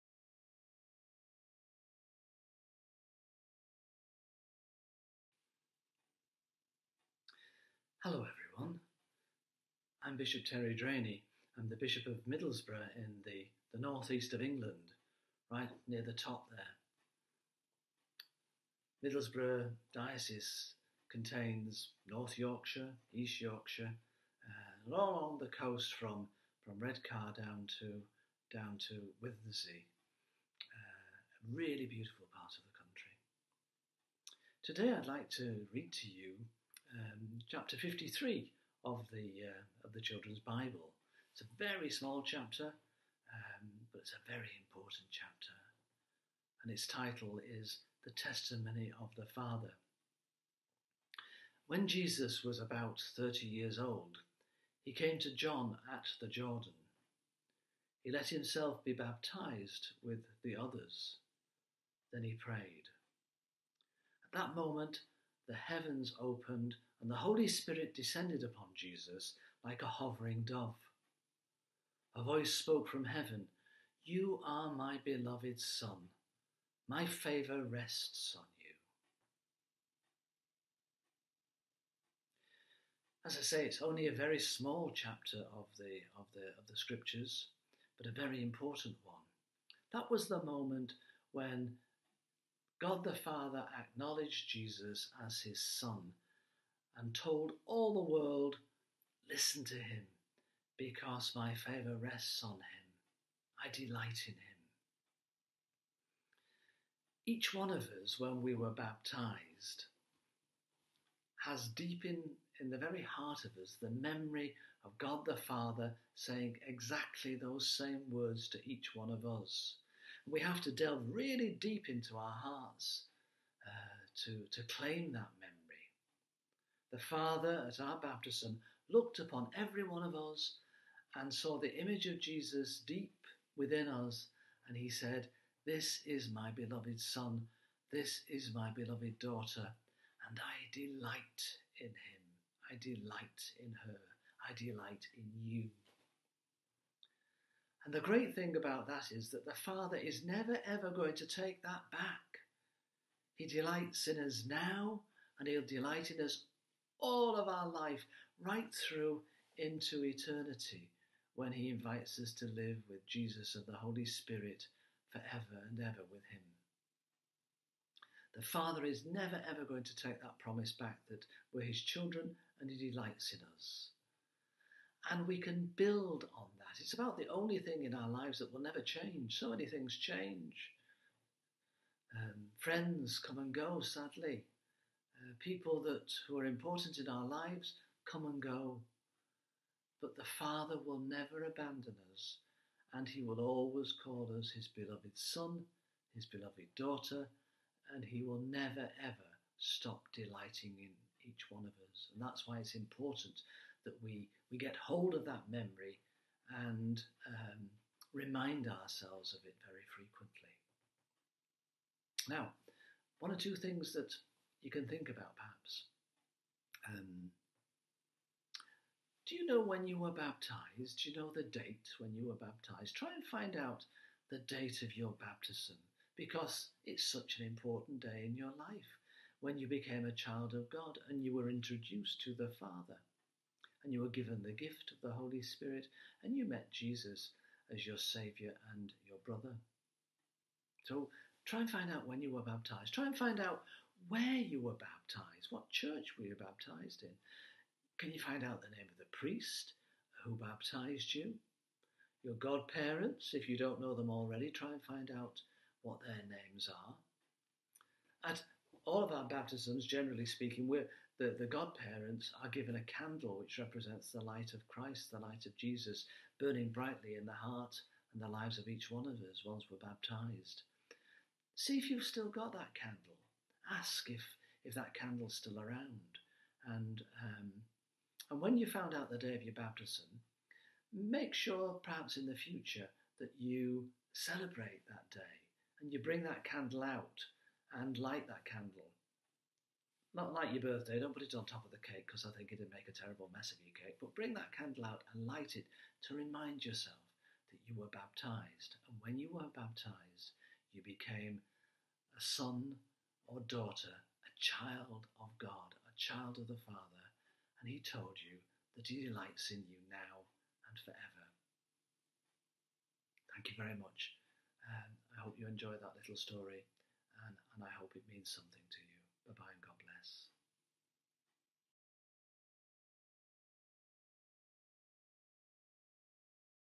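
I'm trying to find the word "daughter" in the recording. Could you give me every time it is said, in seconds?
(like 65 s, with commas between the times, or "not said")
139 s, 196 s, 303 s.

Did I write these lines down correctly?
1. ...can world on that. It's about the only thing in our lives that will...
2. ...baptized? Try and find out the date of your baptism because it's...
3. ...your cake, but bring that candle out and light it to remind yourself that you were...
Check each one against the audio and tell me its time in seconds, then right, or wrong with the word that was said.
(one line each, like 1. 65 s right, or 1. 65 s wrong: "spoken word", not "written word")
1. 175 s wrong: "build", not "world"
2. 222 s right
3. 293 s right.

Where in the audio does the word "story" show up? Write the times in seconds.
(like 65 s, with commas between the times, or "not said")
316 s.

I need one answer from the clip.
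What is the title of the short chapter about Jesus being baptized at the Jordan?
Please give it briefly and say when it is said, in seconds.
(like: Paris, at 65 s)
The Testimony of the Father, at 48 s.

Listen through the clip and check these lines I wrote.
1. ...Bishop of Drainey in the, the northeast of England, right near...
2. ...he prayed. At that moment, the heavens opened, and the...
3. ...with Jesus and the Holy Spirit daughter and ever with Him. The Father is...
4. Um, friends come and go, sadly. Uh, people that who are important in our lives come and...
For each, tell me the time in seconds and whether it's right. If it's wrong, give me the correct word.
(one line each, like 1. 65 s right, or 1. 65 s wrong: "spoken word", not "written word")
1. 11 s wrong: "Middlesbrough", not "Drainey"
2. 62 s right
3. 162 s wrong: "forever", not "daughter"
4. 182 s right.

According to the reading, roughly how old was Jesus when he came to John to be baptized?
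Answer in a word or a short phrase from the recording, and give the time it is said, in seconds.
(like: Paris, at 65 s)
30, at 53 s.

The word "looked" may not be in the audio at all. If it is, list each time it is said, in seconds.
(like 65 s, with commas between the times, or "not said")
128 s.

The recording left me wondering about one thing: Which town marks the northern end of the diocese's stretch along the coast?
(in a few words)
Redcar.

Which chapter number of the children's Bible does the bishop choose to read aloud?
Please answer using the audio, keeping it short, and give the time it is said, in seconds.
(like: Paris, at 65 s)
53, at 37 s.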